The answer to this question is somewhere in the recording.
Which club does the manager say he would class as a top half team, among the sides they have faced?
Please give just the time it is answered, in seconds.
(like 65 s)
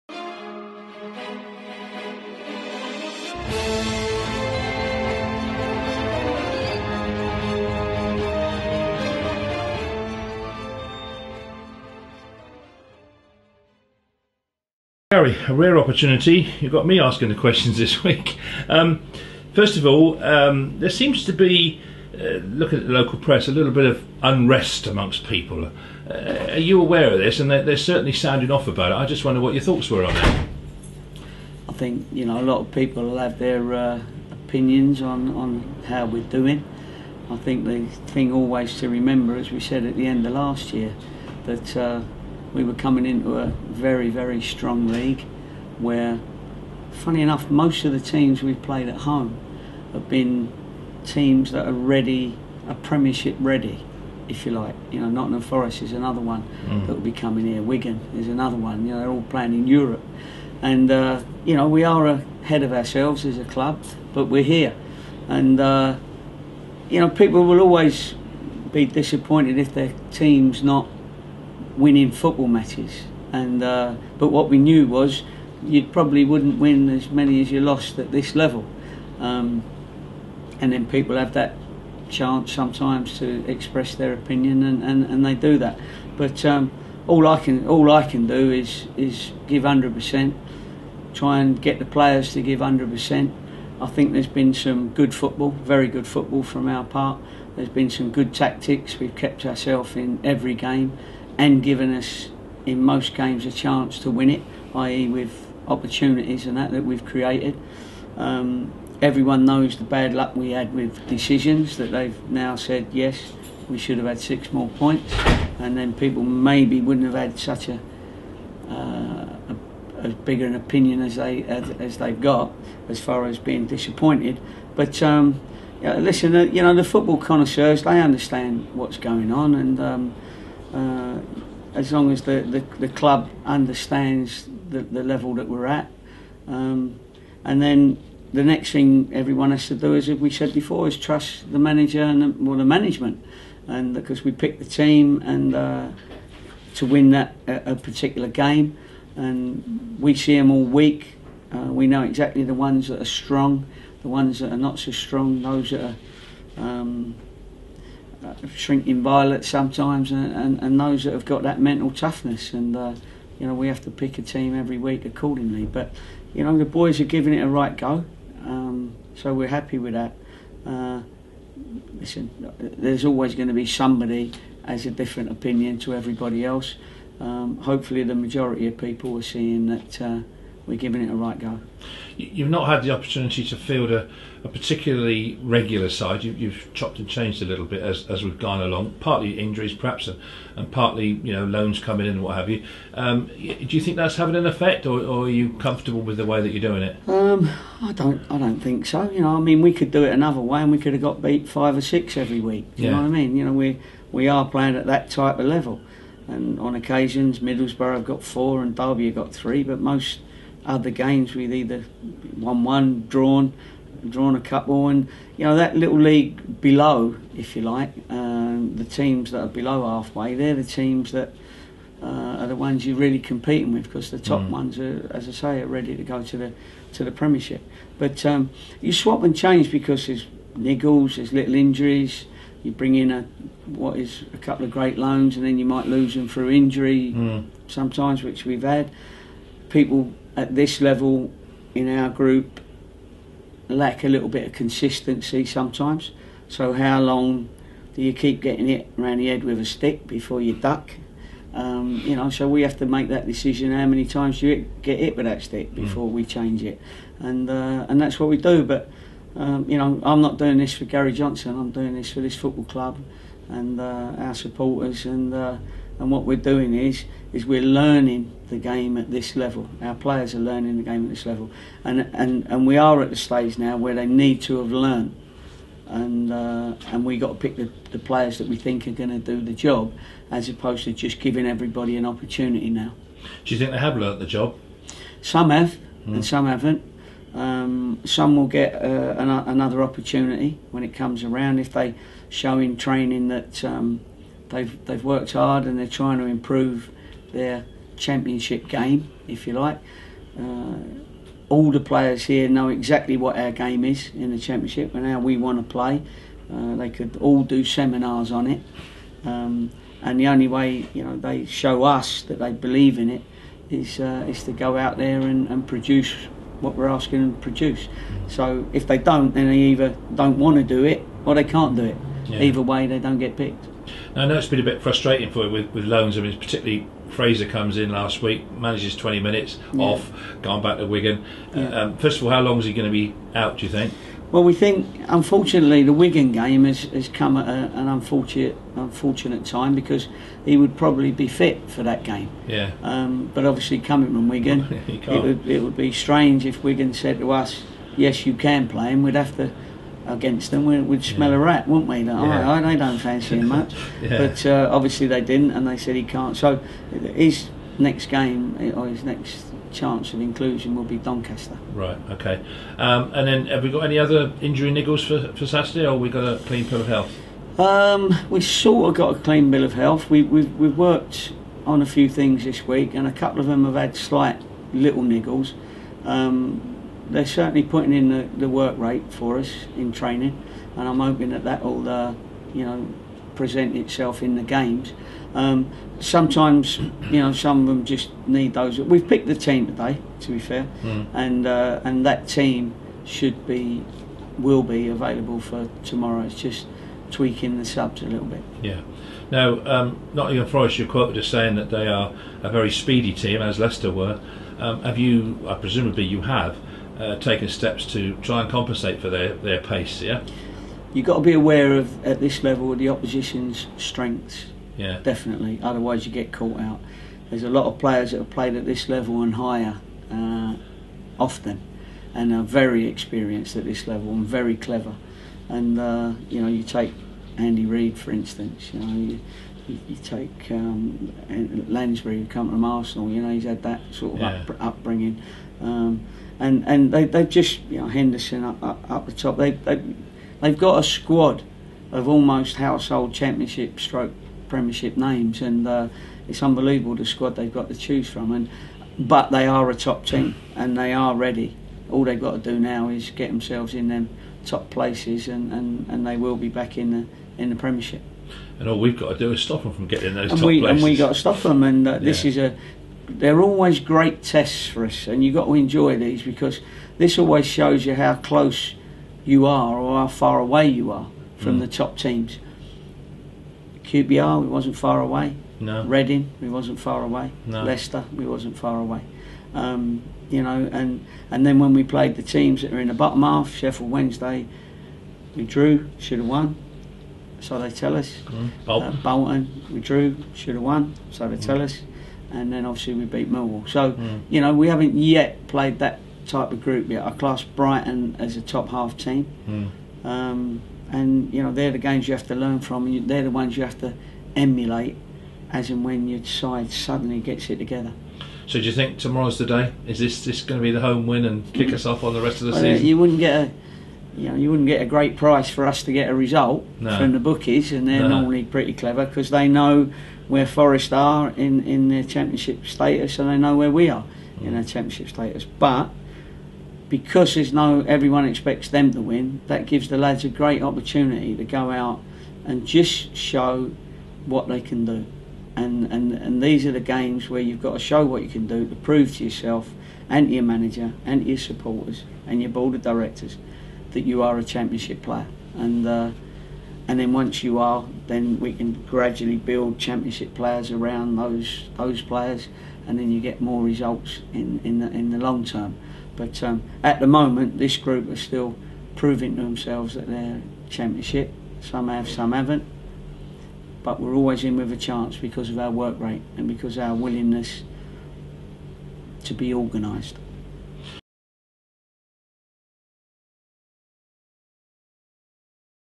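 497 s.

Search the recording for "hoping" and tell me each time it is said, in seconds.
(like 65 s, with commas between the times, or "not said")
380 s.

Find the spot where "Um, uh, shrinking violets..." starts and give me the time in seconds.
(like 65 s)
156 s.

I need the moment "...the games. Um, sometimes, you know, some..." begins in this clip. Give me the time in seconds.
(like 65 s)
384 s.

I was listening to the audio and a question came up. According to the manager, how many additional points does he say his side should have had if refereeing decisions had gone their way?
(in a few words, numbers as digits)
6.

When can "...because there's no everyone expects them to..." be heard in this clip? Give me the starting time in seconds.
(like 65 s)
526 s.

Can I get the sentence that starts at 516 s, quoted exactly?
from the bookies, and they're no.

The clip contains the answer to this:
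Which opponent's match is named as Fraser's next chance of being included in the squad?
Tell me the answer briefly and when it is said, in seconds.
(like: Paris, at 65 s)
Doncaster, at 360 s.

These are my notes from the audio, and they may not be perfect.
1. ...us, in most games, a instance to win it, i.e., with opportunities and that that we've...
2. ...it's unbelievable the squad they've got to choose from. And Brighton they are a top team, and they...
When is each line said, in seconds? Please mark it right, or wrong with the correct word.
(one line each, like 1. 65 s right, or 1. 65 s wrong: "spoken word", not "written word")
1. 101 s wrong: "chance", not "instance"
2. 446 s wrong: "But", not "Brighton".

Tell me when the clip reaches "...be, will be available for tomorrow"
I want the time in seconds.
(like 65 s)
393 s.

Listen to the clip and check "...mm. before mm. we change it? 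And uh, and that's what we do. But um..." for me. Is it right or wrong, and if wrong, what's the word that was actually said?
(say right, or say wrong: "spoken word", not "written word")
right.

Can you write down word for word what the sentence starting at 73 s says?
And uh, but what we knew was you probably wouldn't win as many as you lost at this level.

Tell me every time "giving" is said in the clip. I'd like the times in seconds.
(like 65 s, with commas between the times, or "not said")
167 s, 180 s, 281 s.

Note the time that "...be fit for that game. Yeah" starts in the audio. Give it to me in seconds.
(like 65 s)
341 s.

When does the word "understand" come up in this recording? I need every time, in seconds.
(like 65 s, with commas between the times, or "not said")
128 s, 133 s.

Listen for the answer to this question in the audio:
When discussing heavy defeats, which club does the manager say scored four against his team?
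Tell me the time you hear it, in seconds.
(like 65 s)
207 s.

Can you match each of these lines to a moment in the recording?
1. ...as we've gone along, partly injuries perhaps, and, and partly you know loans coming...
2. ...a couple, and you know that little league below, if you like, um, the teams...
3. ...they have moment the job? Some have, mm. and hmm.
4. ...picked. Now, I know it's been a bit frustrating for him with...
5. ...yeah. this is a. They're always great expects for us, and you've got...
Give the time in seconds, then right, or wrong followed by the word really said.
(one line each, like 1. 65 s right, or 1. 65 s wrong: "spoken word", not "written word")
1. 188 s right
2. 214 s right
3. 283 s wrong: "learnt", not "moment"
4. 323 s right
5. 461 s wrong: "tests", not "expects".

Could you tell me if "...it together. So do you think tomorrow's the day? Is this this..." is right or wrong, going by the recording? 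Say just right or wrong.
right.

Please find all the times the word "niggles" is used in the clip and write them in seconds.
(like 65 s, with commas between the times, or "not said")
230 s, 364 s, 375 s.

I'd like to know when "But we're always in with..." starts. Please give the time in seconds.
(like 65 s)
563 s.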